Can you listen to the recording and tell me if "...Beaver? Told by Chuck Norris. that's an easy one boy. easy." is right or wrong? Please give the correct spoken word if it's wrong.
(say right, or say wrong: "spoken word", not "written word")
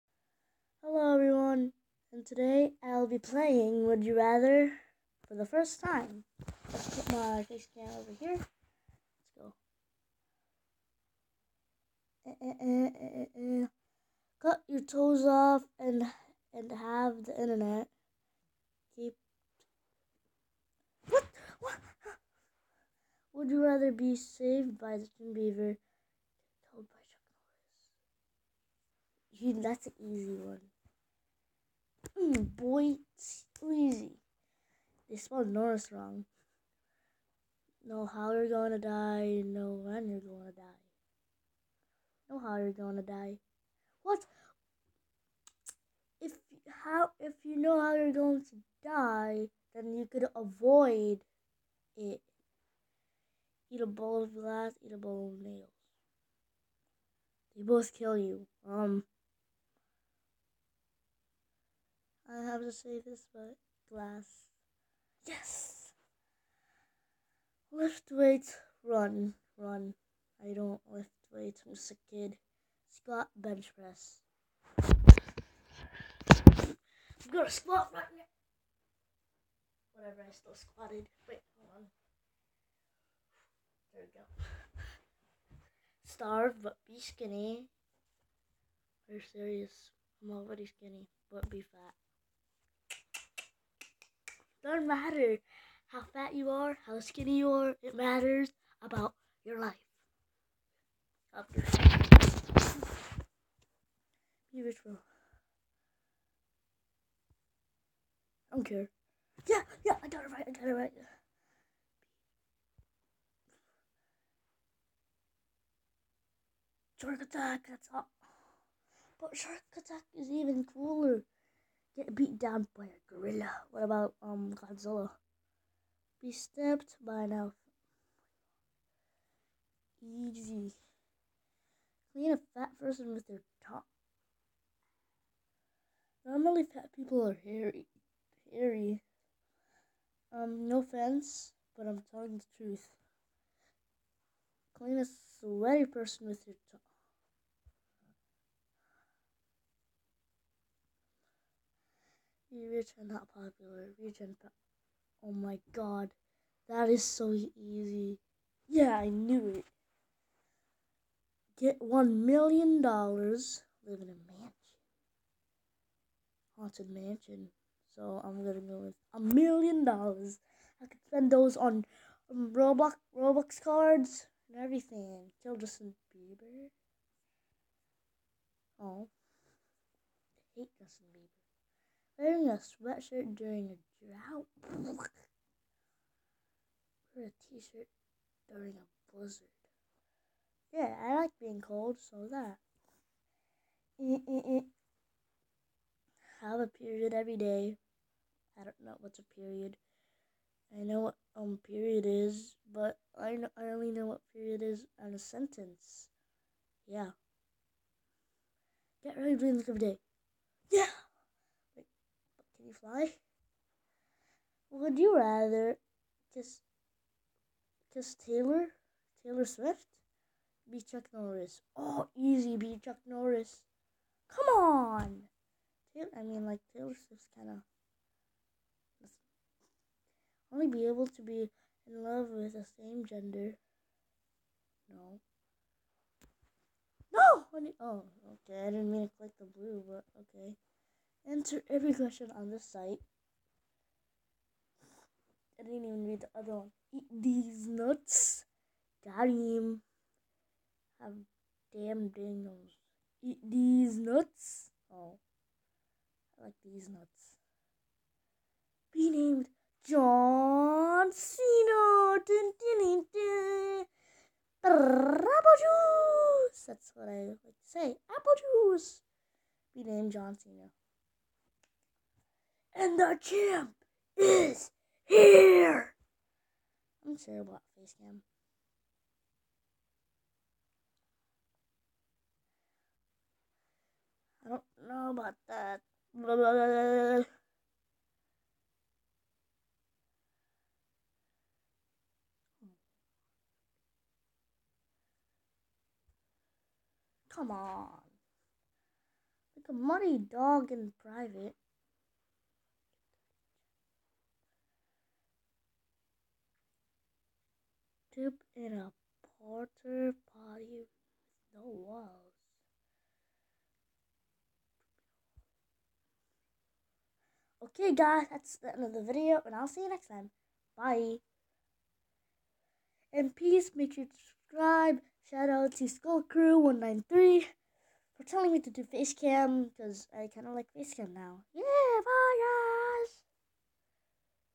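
right.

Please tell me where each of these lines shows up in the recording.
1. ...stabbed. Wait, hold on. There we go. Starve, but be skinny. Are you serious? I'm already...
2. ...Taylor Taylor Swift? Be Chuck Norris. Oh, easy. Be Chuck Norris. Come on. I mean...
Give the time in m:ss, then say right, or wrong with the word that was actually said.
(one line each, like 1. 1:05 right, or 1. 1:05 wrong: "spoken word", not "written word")
1. 1:20 wrong: "squatted", not "stabbed"
2. 3:38 right.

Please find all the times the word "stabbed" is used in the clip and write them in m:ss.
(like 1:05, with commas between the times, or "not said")
2:06.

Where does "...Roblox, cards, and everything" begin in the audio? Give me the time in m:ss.
2:52.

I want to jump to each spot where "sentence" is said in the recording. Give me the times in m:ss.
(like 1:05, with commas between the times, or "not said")
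3:25.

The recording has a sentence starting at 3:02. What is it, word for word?
Wearing a sweatshirt during a drought.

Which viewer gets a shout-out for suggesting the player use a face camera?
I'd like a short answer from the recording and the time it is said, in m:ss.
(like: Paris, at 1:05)
Skull Crew 193, at 5:25.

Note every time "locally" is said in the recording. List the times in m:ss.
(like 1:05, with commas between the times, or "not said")
not said.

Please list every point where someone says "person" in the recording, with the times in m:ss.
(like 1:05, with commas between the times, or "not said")
2:12, 2:25.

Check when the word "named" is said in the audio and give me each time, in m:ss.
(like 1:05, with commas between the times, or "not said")
4:19, 4:29.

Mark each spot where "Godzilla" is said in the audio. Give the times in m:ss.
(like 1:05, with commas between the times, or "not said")
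2:04.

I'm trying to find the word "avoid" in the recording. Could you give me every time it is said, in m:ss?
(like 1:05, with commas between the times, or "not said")
0:50.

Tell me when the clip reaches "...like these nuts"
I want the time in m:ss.
4:16.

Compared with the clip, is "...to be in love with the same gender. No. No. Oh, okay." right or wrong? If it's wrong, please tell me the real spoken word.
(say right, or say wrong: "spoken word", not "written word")
right.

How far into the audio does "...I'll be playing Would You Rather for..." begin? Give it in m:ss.
0:02.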